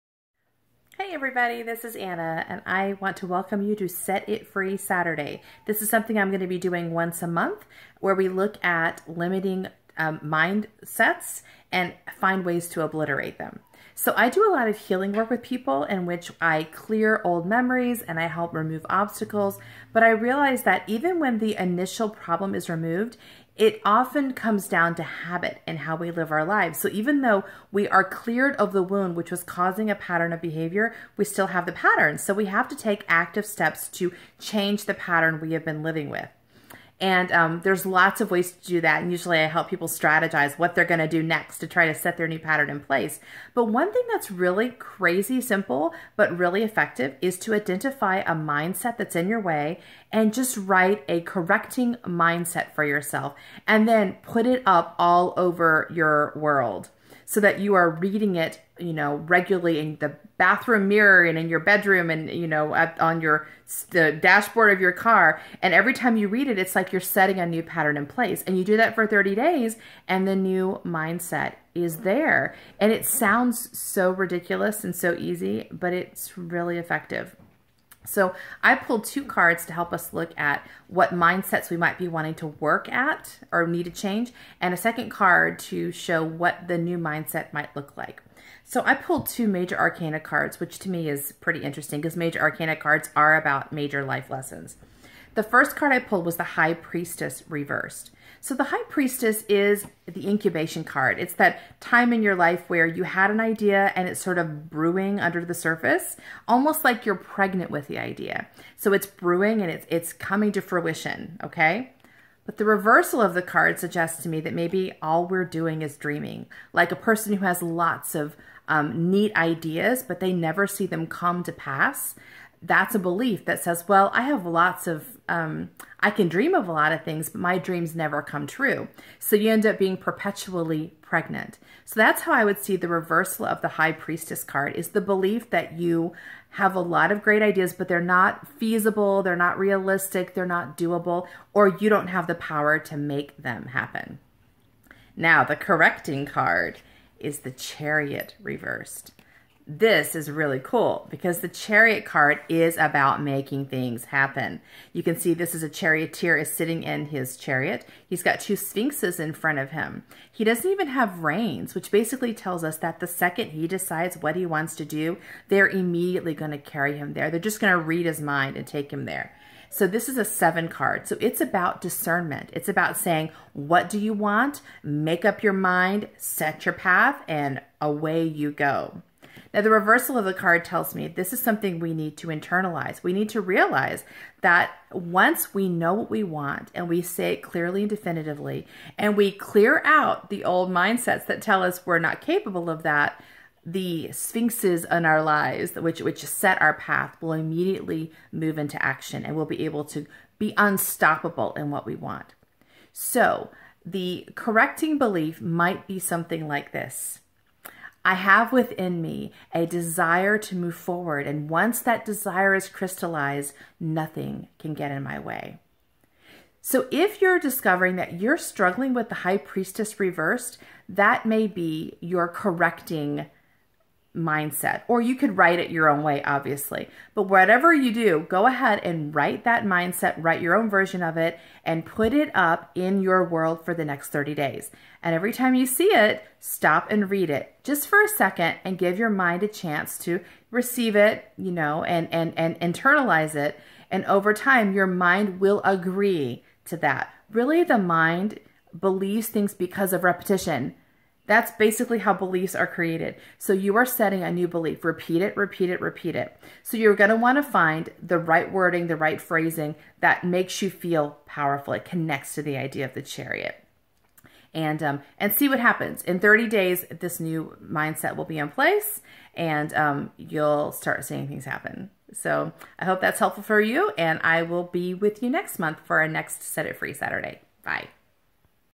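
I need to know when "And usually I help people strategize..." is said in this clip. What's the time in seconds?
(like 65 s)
39 s.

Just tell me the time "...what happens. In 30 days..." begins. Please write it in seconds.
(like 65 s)
265 s.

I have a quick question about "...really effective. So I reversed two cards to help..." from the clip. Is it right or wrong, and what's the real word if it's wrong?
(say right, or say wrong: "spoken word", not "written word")
wrong: "pulled", not "reversed".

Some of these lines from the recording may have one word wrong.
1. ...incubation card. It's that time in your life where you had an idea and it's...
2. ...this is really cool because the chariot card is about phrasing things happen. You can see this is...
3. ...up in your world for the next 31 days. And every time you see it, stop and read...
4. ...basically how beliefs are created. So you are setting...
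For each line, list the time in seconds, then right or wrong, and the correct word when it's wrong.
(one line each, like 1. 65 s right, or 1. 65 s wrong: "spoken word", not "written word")
1. 100 s right
2. 149 s wrong: "making", not "phrasing"
3. 232 s wrong: "30", not "31"
4. 251 s right.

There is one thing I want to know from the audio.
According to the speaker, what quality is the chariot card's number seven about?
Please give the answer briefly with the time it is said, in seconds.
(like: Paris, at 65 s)
Discernment, at 171 s.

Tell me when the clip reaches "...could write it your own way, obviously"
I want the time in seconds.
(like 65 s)
225 s.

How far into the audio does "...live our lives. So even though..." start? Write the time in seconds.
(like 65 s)
26 s.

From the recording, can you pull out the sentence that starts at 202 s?
So, the correcting belief might be something like this.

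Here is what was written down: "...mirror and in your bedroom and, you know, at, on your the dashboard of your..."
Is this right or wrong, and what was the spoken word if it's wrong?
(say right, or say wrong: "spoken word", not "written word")
right.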